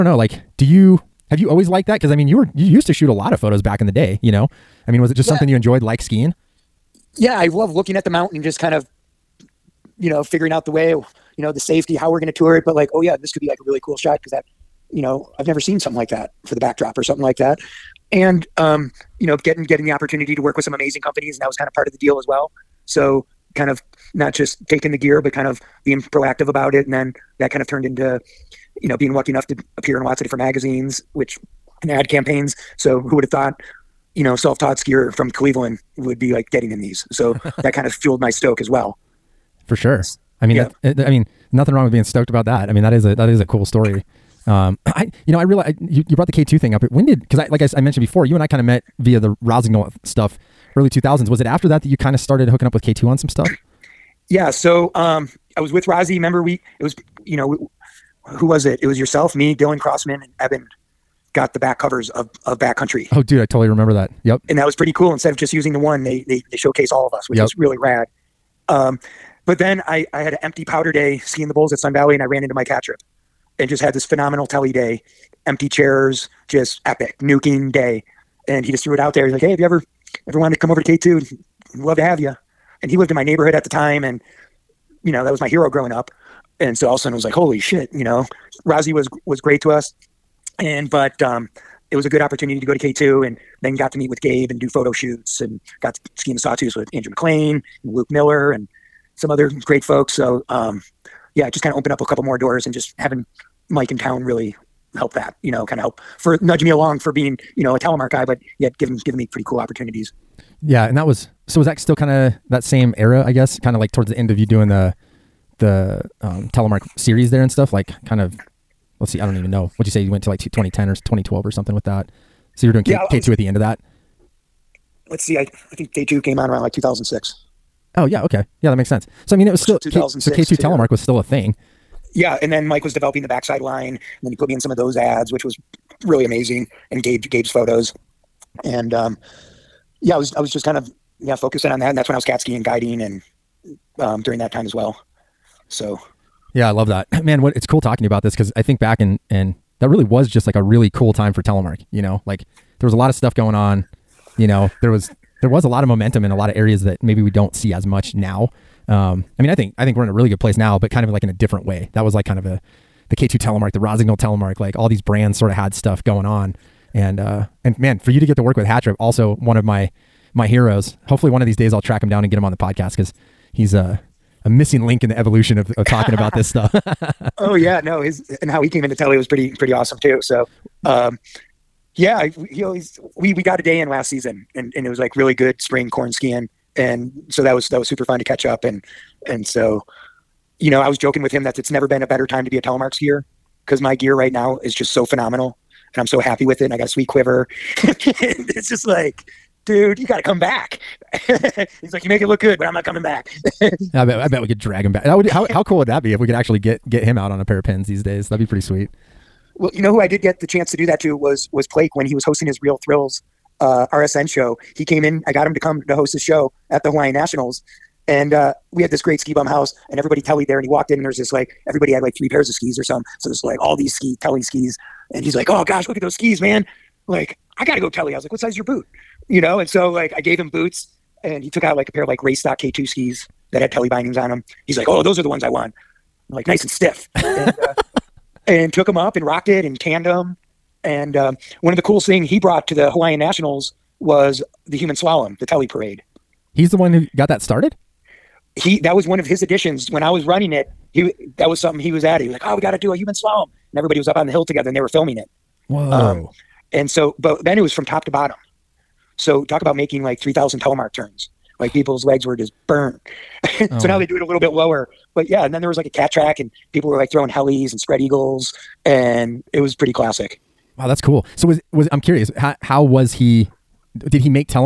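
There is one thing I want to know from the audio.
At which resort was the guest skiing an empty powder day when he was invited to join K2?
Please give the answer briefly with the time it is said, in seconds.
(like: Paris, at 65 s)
Sun Valley, at 71 s.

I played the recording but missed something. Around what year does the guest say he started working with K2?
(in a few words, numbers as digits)
2006.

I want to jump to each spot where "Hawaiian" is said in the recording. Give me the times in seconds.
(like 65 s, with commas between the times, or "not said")
216 s, 242 s.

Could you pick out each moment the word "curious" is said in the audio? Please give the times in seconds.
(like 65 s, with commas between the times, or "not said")
272 s.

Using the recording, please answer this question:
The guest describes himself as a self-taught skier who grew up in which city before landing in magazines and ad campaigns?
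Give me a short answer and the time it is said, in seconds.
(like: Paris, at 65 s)
Cleveland, at 35 s.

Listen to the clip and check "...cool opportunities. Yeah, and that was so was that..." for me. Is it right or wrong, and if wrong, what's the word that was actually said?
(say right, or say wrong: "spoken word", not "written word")
right.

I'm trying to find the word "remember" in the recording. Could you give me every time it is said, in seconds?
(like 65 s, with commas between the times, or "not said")
56 s, 63 s.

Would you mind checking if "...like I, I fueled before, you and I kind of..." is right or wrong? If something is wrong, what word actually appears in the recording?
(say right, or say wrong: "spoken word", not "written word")
wrong: "mentioned", not "fueled".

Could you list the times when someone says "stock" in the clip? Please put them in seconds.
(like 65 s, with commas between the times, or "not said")
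232 s.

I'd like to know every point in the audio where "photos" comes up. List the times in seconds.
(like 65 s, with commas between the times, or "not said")
3 s, 94 s, 137 s.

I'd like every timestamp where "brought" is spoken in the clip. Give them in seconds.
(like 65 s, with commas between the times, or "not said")
46 s, 242 s.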